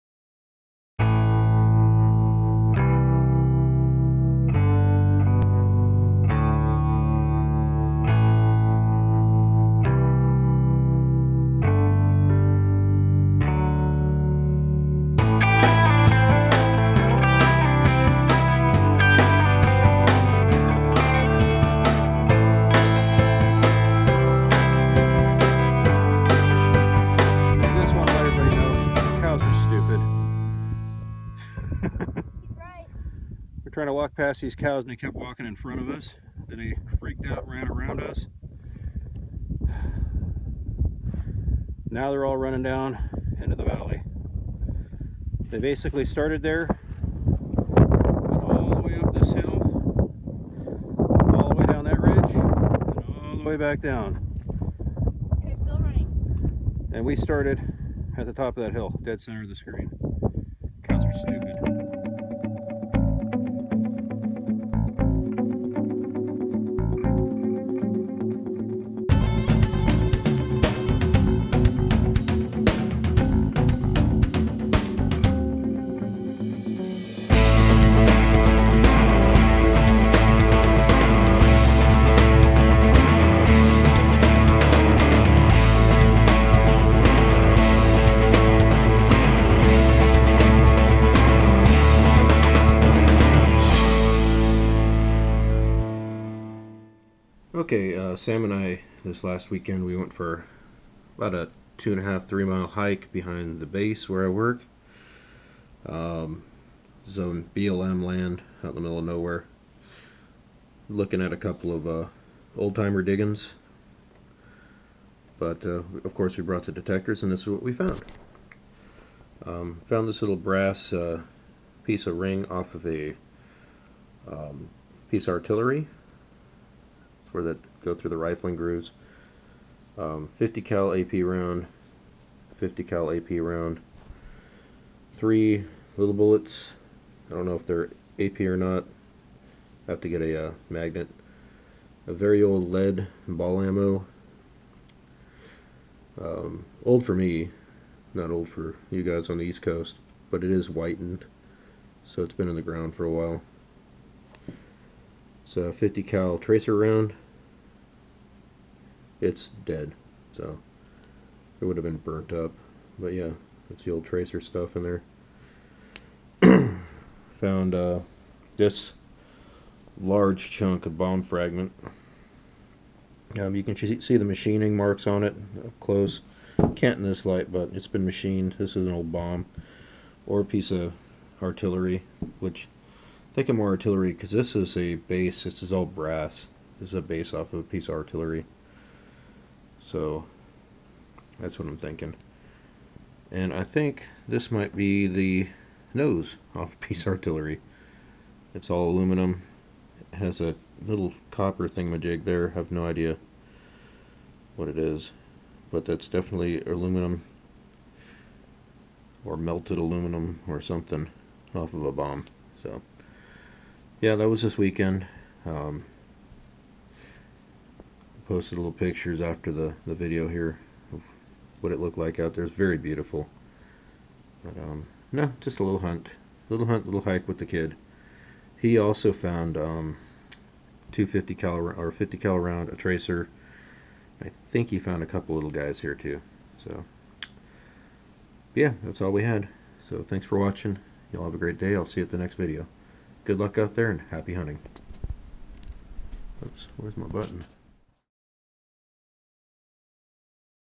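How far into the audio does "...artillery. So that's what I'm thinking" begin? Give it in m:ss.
3:07.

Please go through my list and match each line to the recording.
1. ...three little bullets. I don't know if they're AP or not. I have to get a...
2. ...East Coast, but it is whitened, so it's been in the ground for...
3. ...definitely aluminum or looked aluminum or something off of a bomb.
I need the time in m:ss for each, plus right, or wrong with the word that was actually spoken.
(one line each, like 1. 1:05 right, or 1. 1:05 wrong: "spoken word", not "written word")
1. 2:15 right
2. 2:29 right
3. 3:26 wrong: "melted", not "looked".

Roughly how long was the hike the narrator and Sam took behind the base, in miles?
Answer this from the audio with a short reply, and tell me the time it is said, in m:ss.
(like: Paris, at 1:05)
2.5 to 3 miles, at 1:41.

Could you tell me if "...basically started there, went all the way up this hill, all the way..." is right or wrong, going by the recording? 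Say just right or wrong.
right.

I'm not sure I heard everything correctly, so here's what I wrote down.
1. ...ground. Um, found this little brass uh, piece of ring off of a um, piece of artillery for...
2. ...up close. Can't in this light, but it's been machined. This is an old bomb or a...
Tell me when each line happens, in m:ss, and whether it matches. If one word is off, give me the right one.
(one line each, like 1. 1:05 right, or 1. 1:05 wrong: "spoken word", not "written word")
1. 1:57 wrong: "found", not "ground"
2. 2:55 right.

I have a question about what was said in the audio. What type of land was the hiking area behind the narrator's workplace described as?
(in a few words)
BLM land.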